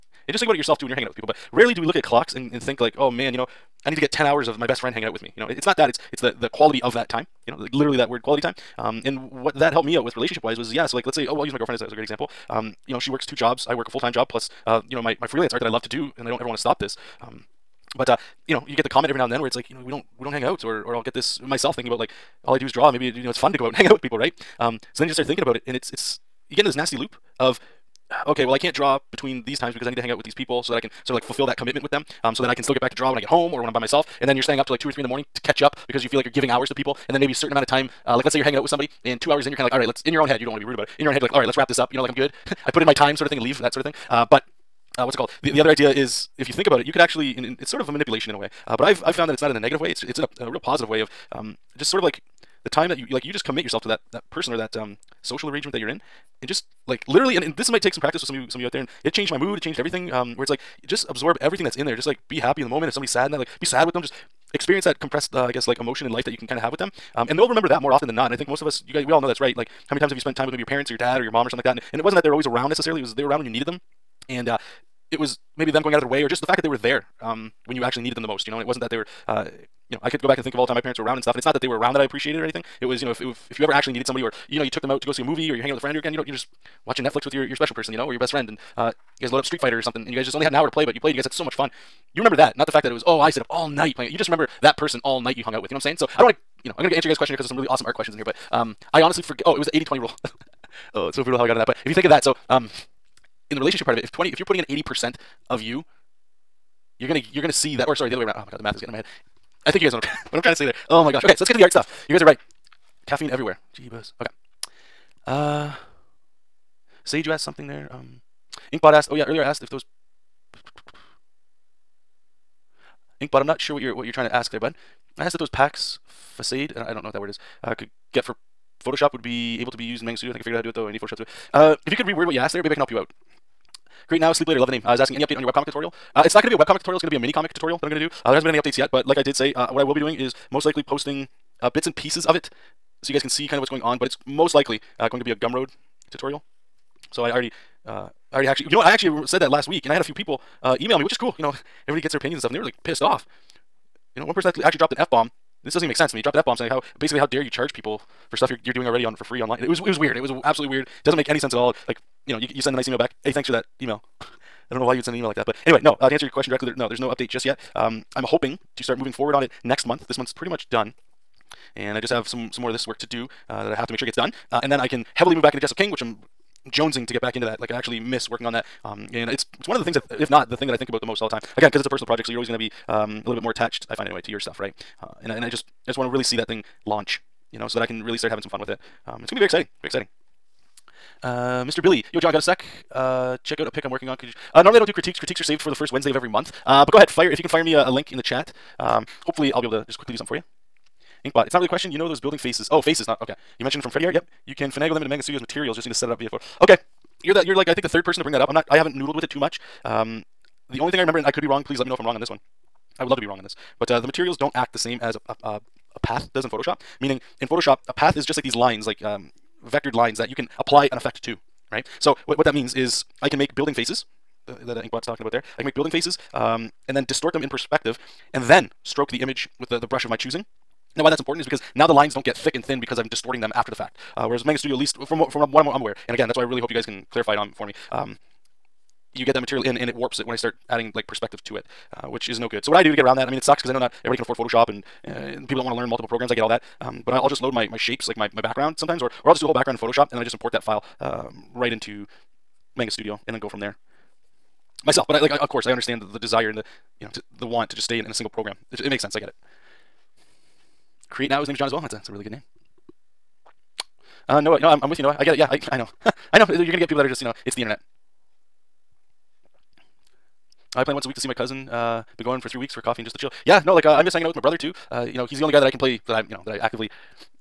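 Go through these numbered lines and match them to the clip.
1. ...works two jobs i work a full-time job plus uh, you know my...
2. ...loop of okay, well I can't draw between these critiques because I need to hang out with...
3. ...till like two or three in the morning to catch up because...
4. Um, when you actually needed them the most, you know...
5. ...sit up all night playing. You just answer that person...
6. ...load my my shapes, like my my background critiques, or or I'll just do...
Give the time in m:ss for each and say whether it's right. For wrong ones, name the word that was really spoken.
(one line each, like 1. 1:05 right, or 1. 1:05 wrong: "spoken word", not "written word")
1. 0:13 right
2. 0:26 wrong: "times", not "critiques"
3. 0:34 right
4. 1:17 right
5. 1:33 wrong: "remember", not "answer"
6. 4:07 wrong: "sometimes", not "critiques".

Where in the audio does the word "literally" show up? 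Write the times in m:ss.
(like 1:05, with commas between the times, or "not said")
0:07, 0:57.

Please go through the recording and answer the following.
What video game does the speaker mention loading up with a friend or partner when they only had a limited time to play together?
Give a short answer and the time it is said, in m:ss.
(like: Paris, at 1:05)
Street Fighter, at 1:29.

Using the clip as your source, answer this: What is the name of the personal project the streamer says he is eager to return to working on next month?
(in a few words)
Jessup King.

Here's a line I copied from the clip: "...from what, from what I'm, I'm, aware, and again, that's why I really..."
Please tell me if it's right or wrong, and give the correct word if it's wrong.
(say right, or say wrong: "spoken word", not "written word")
right.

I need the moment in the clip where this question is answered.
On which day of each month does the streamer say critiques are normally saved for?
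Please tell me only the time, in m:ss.
3:15.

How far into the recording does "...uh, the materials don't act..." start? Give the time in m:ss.
3:33.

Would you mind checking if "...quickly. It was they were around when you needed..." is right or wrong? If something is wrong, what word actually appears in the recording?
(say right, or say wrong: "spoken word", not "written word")
wrong: "necessarily", not "quickly".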